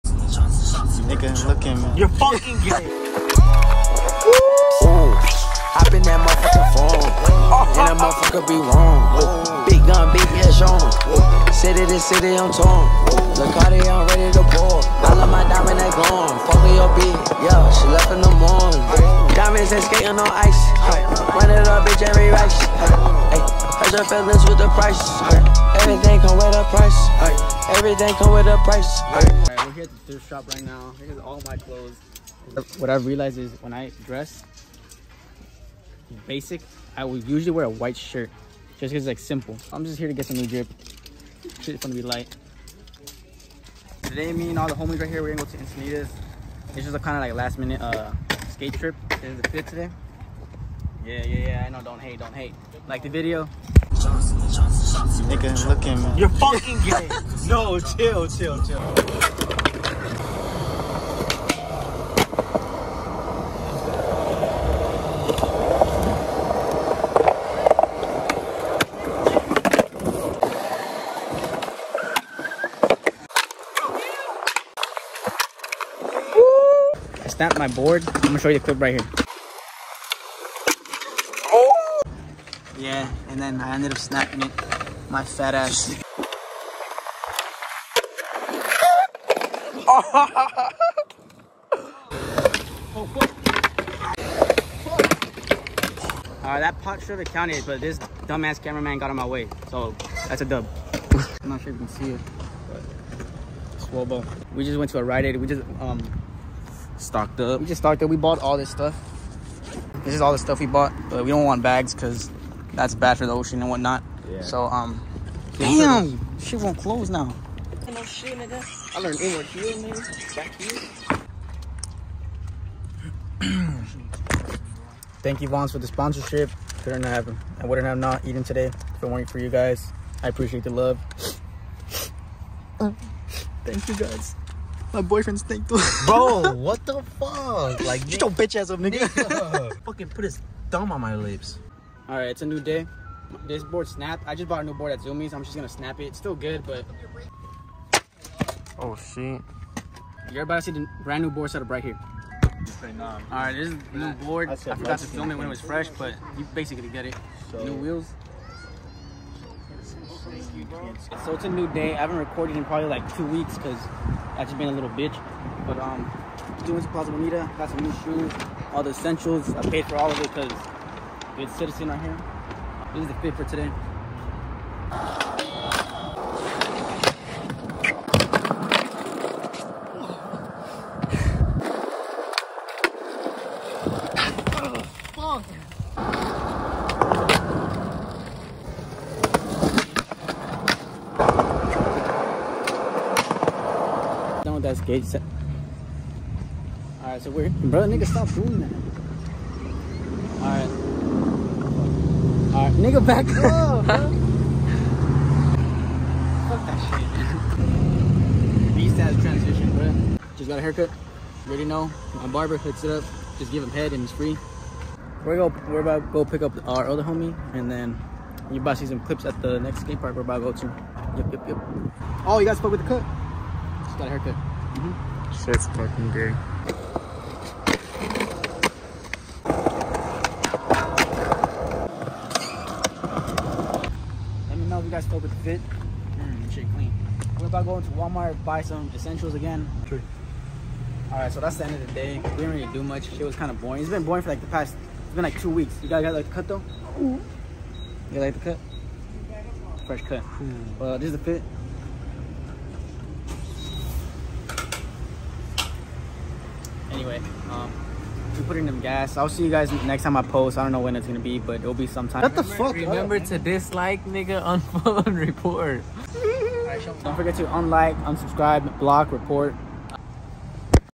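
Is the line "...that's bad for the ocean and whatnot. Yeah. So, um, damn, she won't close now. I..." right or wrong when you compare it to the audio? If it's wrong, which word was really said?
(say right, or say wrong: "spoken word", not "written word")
right.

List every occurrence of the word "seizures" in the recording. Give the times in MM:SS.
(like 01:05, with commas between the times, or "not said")
not said.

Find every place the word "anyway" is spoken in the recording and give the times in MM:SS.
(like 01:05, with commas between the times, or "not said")
04:17.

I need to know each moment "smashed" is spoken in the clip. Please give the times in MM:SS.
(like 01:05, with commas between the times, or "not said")
not said.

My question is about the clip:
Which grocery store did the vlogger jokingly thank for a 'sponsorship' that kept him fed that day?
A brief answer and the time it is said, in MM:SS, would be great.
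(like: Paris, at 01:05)
Vons, at 02:05.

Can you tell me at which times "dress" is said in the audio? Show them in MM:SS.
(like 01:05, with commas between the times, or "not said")
00:34.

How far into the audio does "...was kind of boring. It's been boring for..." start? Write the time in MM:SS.
04:03.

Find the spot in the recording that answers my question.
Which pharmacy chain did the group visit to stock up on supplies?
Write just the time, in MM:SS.
01:45.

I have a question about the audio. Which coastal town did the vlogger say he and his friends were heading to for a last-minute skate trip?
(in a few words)
Encinitas.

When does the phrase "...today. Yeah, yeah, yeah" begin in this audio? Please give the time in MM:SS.
00:49.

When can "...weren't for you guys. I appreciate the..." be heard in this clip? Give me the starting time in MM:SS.
02:09.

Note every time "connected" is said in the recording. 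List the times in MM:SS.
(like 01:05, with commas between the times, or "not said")
not said.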